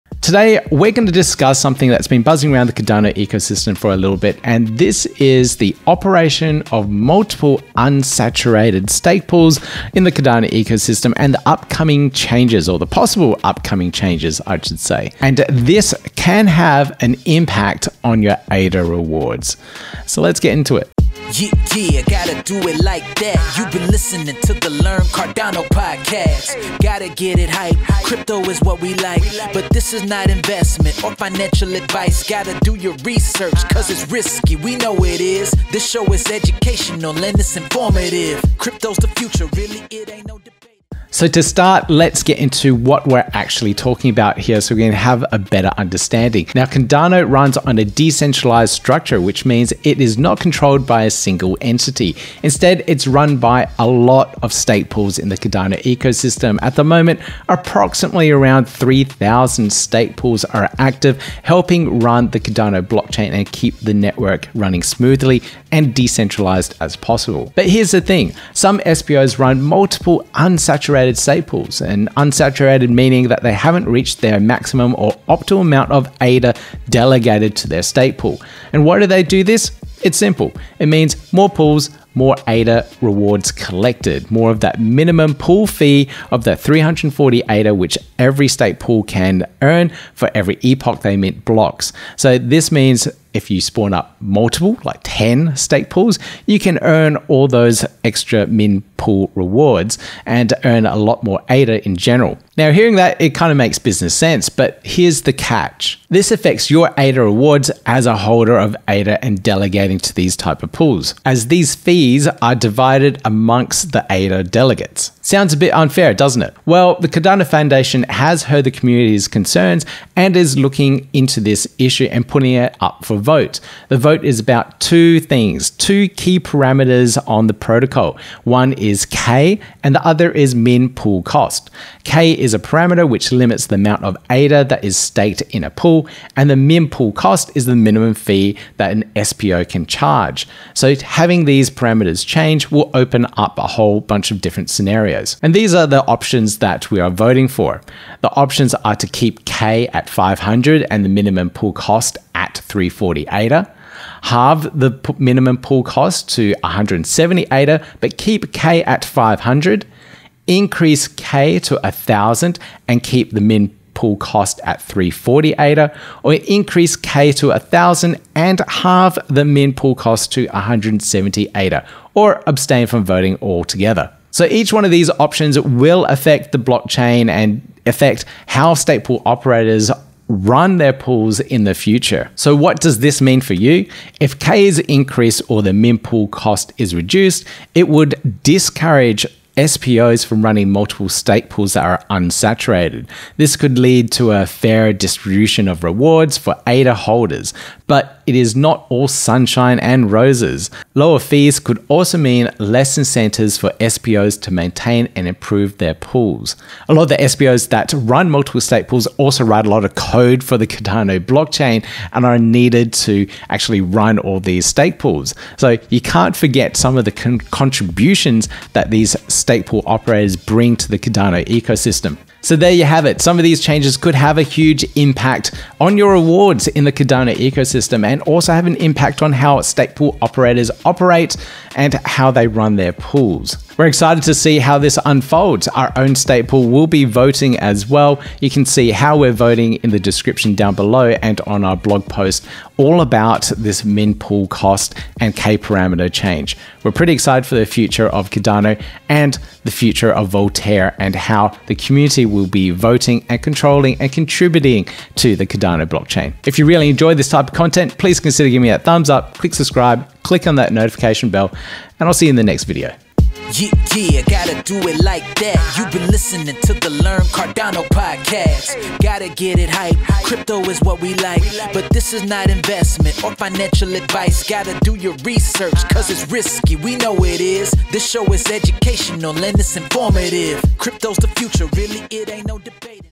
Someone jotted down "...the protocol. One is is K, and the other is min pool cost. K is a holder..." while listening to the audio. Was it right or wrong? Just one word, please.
wrong.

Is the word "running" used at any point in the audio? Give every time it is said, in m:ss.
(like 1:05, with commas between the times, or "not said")
1:04, 3:10.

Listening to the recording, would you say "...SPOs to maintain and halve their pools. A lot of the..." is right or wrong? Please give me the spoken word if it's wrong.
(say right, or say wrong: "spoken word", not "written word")
wrong: "improve", not "halve".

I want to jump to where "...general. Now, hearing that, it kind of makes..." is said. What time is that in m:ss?
1:41.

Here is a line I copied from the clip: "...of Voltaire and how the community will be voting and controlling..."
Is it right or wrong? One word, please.
right.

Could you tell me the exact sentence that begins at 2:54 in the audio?
So each one of these options will affect the blockchain and affect how stake pool operators run their pools in the future.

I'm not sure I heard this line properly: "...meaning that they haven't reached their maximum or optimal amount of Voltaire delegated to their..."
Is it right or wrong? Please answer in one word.
wrong.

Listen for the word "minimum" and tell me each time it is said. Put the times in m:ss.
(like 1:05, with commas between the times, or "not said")
1:24, 2:17, 2:31, 2:35.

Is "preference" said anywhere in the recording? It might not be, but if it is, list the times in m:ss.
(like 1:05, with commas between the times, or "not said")
not said.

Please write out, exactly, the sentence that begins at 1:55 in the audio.
Sounds a bit unfair, doesn't it?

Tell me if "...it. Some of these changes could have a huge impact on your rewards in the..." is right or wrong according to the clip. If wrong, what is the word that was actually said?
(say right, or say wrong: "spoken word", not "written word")
right.